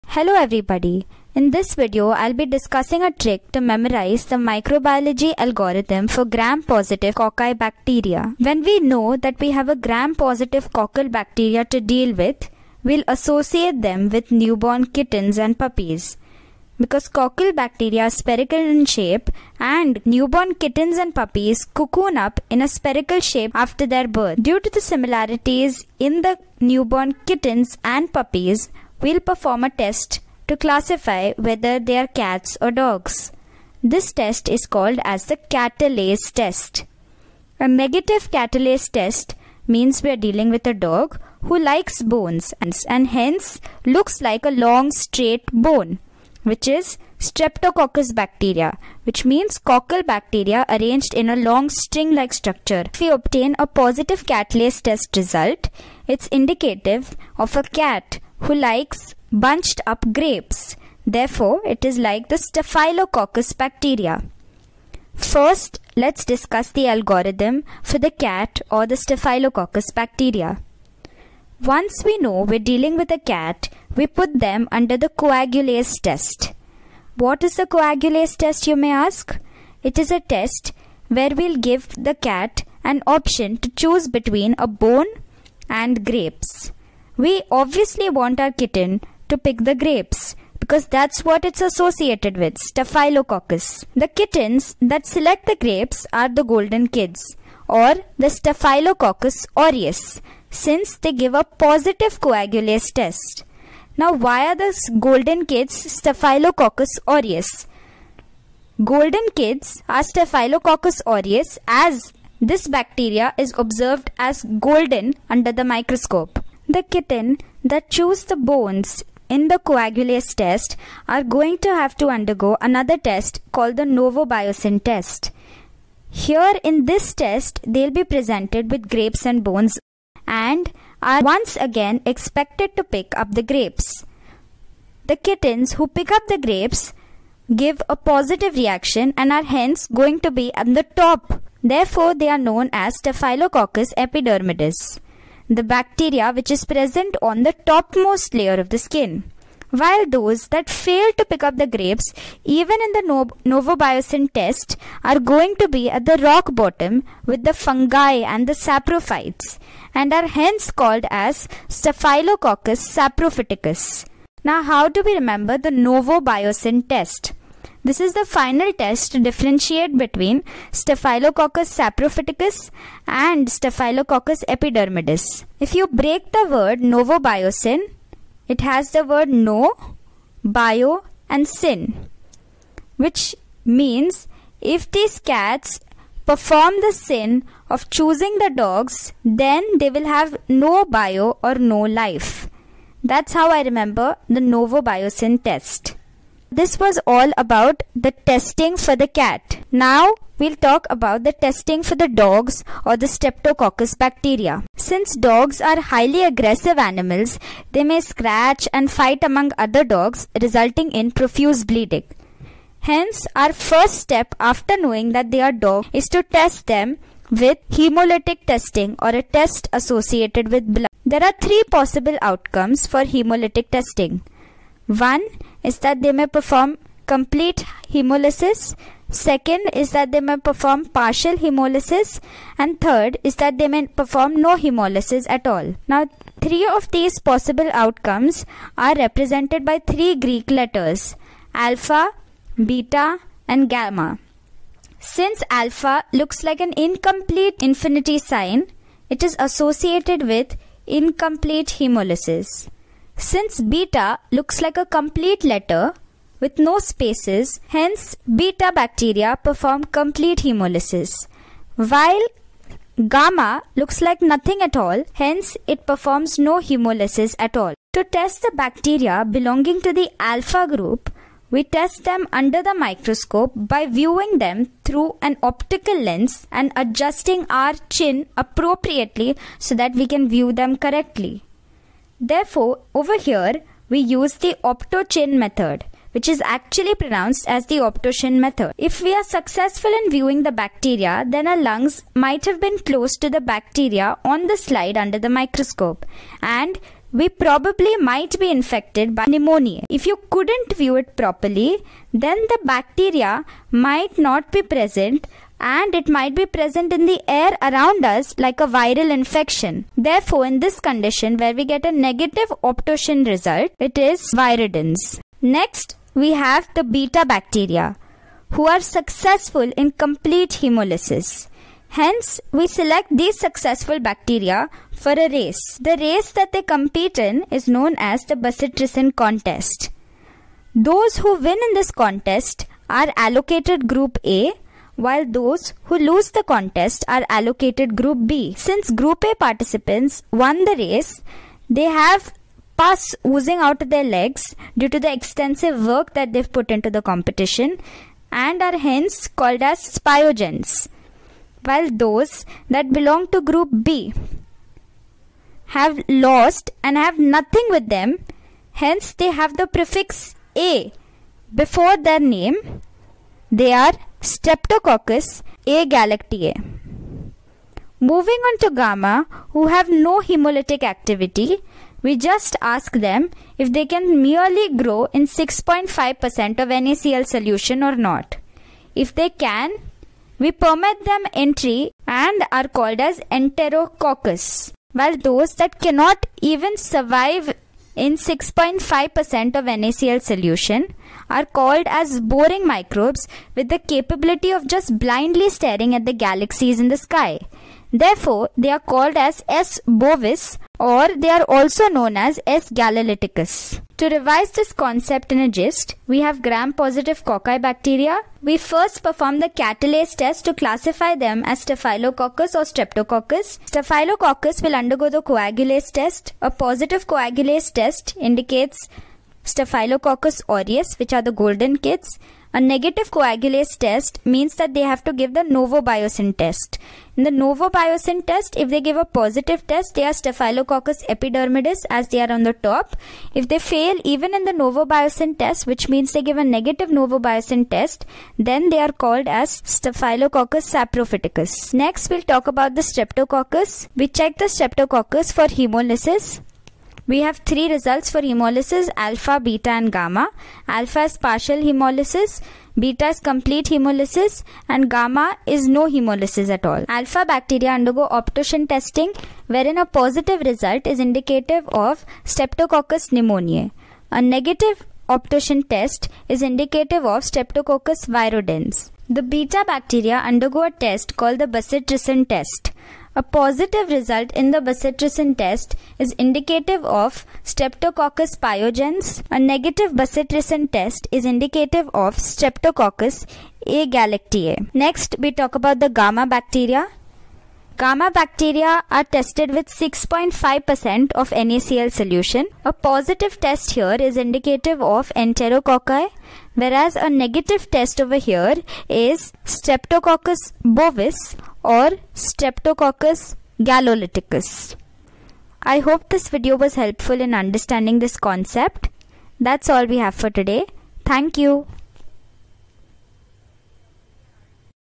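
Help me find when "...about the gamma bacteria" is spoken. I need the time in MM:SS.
08:05.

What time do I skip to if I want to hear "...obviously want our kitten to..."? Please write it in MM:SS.
01:27.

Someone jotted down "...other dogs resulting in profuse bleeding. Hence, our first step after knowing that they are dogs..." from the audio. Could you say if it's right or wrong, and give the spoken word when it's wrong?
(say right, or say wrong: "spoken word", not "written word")
right.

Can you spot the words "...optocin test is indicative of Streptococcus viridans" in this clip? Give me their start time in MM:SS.
07:45.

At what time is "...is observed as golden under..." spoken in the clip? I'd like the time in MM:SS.
01:53.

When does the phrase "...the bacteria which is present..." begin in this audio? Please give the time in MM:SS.
02:25.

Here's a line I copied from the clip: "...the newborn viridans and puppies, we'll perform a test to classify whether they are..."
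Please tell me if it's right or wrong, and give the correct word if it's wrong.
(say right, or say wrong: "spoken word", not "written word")
wrong: "kittens", not "viridans".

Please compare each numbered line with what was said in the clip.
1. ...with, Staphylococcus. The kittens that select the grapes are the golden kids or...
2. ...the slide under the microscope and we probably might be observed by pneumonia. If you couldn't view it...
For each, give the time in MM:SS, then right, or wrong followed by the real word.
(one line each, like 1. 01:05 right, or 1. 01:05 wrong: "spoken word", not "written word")
1. 01:32 right
2. 04:54 wrong: "infected", not "observed".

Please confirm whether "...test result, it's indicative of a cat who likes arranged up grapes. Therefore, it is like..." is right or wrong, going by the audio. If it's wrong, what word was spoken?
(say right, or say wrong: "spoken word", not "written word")
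wrong: "bunched", not "arranged".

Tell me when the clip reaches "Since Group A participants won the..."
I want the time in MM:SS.
05:38.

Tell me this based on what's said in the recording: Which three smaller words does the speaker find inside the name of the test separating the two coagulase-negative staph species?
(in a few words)
No, bio and sin.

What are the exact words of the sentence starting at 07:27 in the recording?
We have three results for hemolysis alpha, beta and gamma.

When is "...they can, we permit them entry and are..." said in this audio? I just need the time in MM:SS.
06:19.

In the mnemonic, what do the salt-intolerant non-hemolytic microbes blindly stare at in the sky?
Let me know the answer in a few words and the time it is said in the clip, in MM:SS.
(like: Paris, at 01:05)
The galaxies, at 06:36.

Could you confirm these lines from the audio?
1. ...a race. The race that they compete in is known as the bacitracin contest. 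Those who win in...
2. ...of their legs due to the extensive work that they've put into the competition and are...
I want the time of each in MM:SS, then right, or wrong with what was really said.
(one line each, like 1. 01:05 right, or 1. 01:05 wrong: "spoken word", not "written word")
1. 05:25 right
2. 05:43 right.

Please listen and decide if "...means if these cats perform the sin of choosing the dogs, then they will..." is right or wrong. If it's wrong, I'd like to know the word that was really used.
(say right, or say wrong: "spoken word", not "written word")
right.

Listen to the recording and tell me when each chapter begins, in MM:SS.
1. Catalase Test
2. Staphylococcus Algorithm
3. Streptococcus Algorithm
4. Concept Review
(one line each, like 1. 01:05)
1. 00:34
2. 01:05
3. 03:16
4. 06:43.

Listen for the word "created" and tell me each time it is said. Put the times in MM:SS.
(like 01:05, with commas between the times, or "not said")
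not said.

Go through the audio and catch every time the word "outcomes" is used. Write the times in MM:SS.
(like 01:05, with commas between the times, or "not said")
03:42, 03:57.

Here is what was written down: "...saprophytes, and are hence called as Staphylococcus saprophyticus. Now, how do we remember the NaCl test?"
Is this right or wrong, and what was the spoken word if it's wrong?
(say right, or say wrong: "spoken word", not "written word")
wrong: "Novobiocin", not "NaCl".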